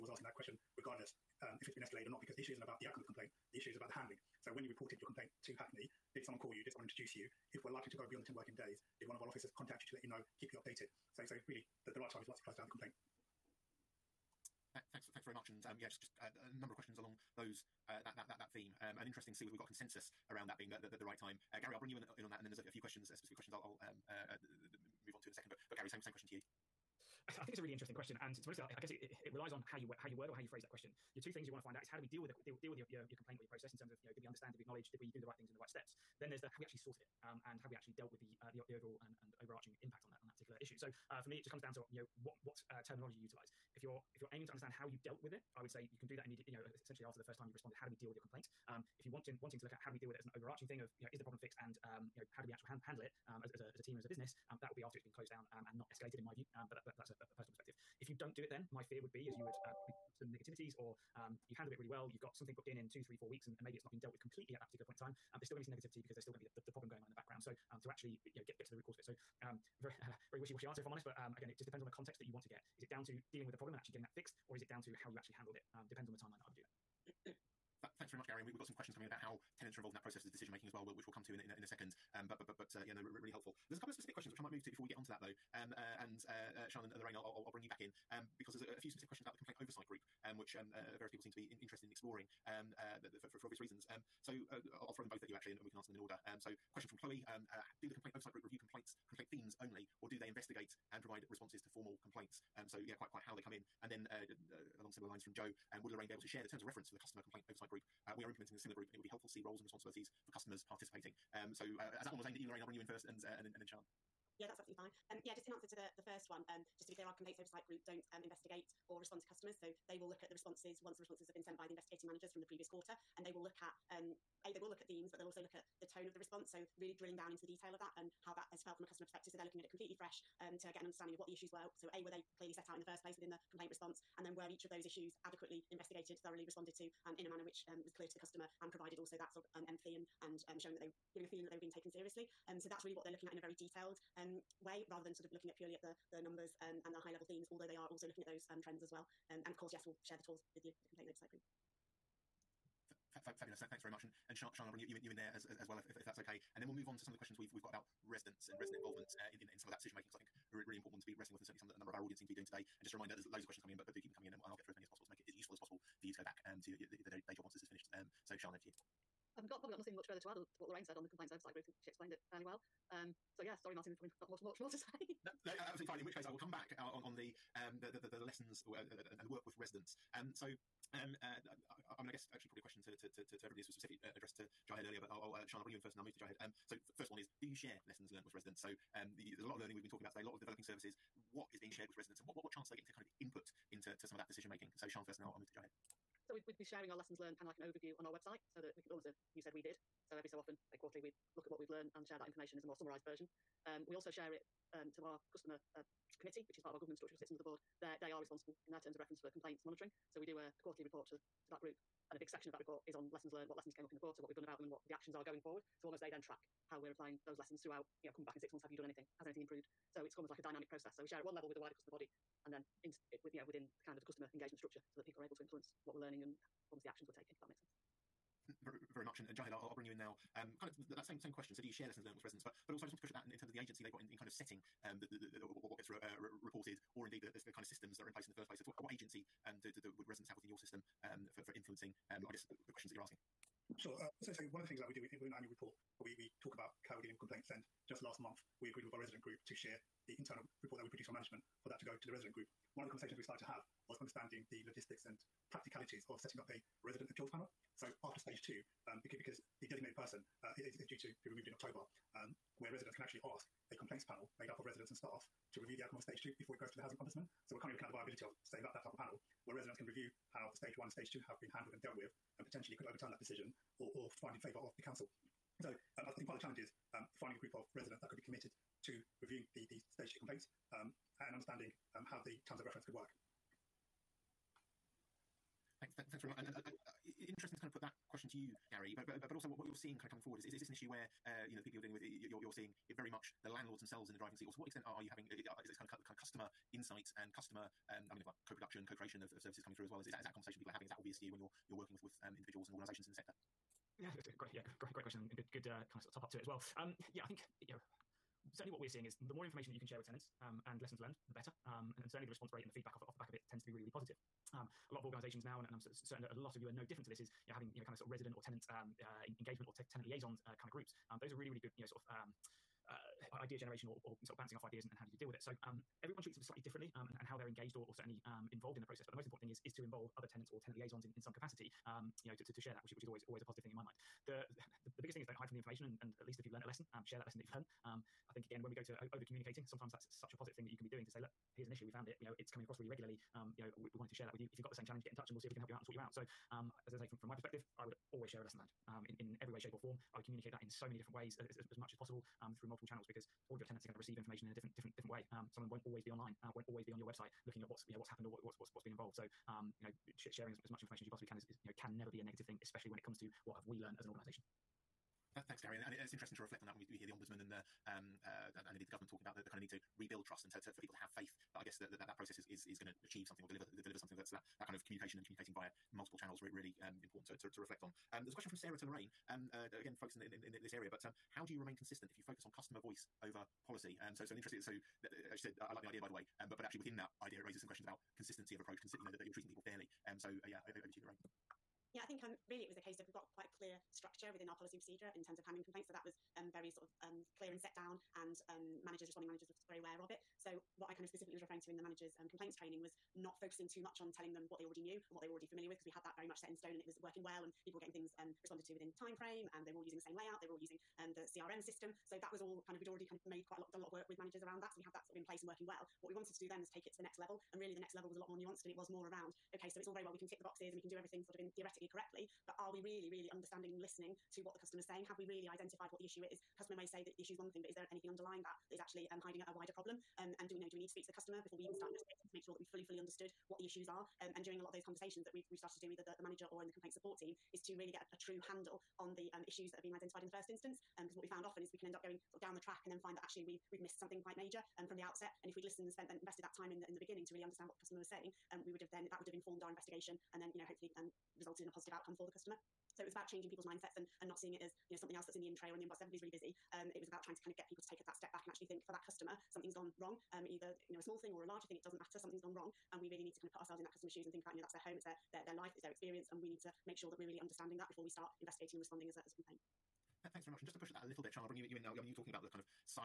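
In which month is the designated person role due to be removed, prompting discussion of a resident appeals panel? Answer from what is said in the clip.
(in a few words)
October.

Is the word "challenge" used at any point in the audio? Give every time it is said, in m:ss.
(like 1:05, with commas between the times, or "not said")
4:36, 5:44.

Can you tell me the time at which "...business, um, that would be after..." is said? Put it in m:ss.
0:54.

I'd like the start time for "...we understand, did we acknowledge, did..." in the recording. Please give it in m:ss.
0:34.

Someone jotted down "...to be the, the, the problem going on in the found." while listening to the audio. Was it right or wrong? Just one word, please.
wrong.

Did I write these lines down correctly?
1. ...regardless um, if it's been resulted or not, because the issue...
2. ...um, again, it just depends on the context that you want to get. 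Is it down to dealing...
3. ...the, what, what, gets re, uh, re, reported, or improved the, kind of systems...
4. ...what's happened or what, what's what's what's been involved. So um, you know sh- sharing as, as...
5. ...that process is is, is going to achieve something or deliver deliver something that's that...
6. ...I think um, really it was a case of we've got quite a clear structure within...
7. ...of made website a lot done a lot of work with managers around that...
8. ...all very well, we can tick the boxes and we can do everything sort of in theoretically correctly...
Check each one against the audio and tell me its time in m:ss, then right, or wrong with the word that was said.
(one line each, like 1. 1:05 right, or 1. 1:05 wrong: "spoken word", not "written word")
1. 0:00 wrong: "escalated", not "resulted"
2. 1:11 right
3. 3:55 wrong: "indeed", not "improved"
4. 5:57 right
5. 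6:12 right
6. 6:32 right
7. 6:53 wrong: "quite", not "website"
8. 6:59 right.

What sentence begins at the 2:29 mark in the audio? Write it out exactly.
Um, and of course, yes, we'll share the tools with you, the complaint oversight group.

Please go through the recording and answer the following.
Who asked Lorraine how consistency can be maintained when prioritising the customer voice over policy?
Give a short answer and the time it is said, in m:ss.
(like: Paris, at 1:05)
Sarah, at 6:18.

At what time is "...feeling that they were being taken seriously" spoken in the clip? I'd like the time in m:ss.
2:21.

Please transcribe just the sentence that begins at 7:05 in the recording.
Have we really identified what the issue is?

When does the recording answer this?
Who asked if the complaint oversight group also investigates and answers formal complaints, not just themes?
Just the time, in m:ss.
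1:36.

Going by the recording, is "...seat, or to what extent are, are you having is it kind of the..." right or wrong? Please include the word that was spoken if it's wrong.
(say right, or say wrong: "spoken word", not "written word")
right.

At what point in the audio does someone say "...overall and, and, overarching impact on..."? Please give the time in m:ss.
0:38.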